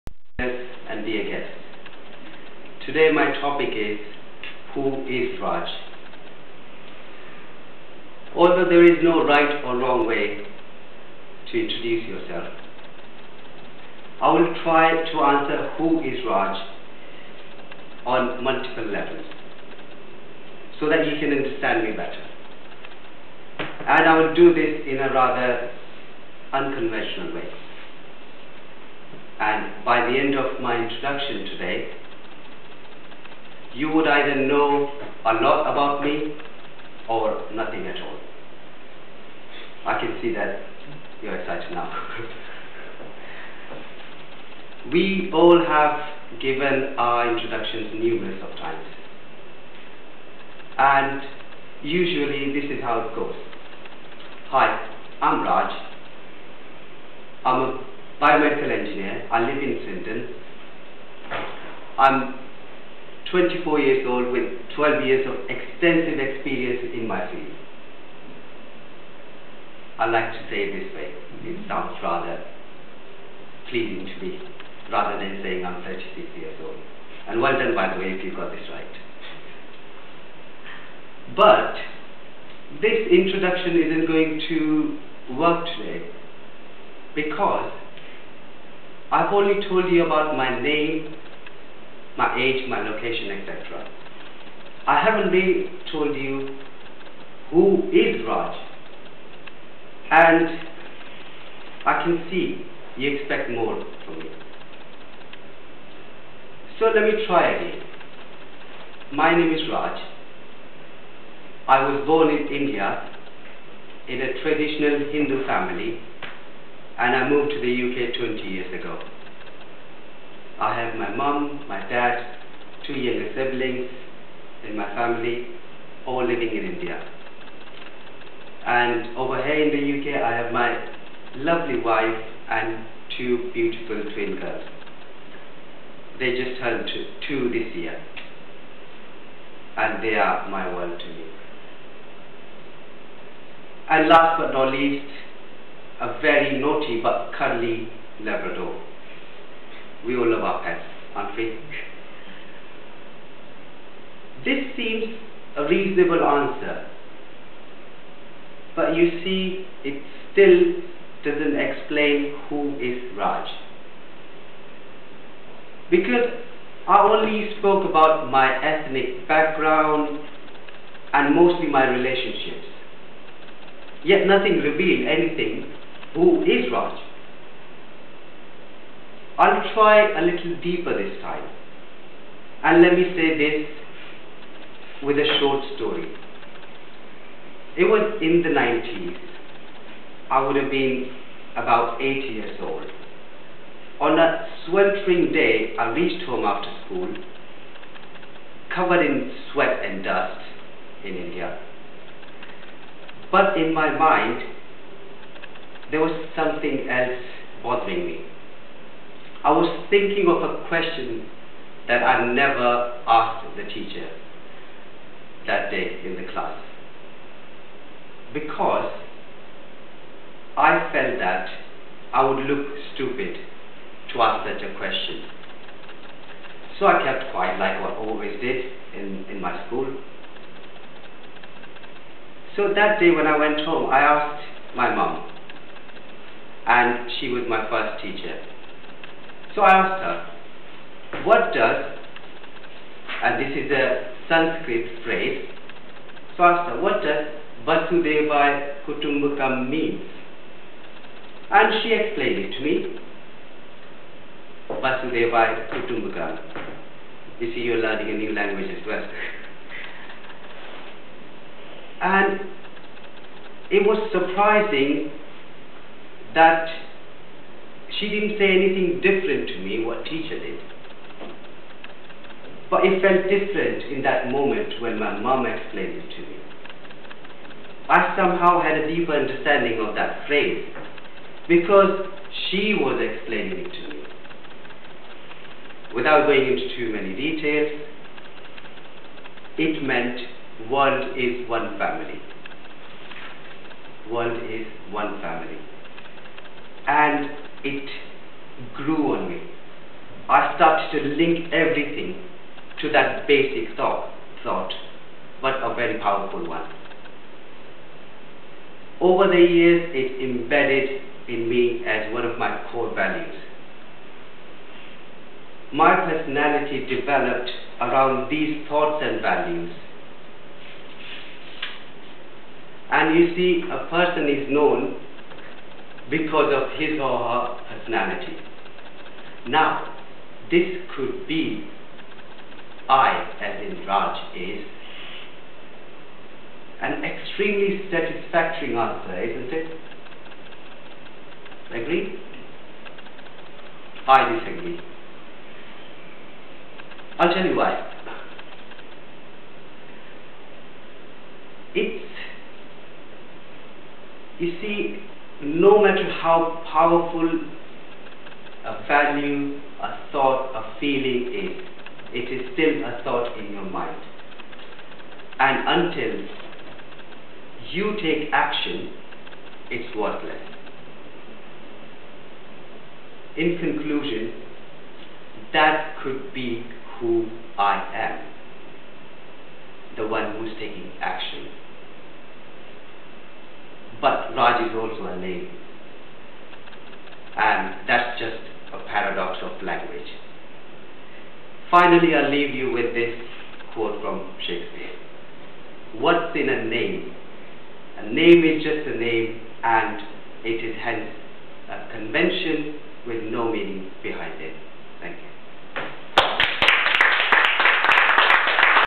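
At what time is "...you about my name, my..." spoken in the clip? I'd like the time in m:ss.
1:29.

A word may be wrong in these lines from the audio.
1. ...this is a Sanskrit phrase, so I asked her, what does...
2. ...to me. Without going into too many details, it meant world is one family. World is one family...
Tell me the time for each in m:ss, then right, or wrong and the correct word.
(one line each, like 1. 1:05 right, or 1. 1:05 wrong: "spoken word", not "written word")
1. 4:03 right
2. 4:43 right.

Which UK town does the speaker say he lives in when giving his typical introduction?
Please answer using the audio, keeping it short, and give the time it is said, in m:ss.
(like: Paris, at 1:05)
Swindon, at 0:59.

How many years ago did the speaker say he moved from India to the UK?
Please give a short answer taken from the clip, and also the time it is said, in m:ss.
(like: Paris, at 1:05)
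20, at 1:58.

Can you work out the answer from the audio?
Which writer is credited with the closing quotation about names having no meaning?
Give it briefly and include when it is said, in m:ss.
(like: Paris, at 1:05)
Shakespeare, at 6:34.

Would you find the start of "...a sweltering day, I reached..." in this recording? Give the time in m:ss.
3:14.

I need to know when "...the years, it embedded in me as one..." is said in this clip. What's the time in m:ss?
5:09.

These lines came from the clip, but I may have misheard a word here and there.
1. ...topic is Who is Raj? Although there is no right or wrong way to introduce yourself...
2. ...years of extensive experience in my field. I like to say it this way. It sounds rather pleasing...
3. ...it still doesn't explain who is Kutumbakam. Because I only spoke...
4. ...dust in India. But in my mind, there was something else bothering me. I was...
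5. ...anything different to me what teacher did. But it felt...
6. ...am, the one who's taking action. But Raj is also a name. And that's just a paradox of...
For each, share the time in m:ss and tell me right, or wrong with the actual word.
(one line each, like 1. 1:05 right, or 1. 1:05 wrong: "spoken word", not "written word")
1. 0:03 right
2. 1:05 right
3. 2:39 wrong: "Raj", not "Kutumbakam"
4. 3:20 right
5. 4:28 right
6. 6:17 right.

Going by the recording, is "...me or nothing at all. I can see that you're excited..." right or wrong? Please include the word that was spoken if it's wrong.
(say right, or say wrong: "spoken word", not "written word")
right.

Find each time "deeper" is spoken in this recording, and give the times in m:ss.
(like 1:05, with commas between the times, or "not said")
3:00, 4:38.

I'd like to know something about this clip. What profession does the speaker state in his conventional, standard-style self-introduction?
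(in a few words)
Biomedical engineer.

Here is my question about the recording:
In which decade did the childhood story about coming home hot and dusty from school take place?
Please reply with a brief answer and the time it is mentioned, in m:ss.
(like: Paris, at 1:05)
The 90s, at 3:08.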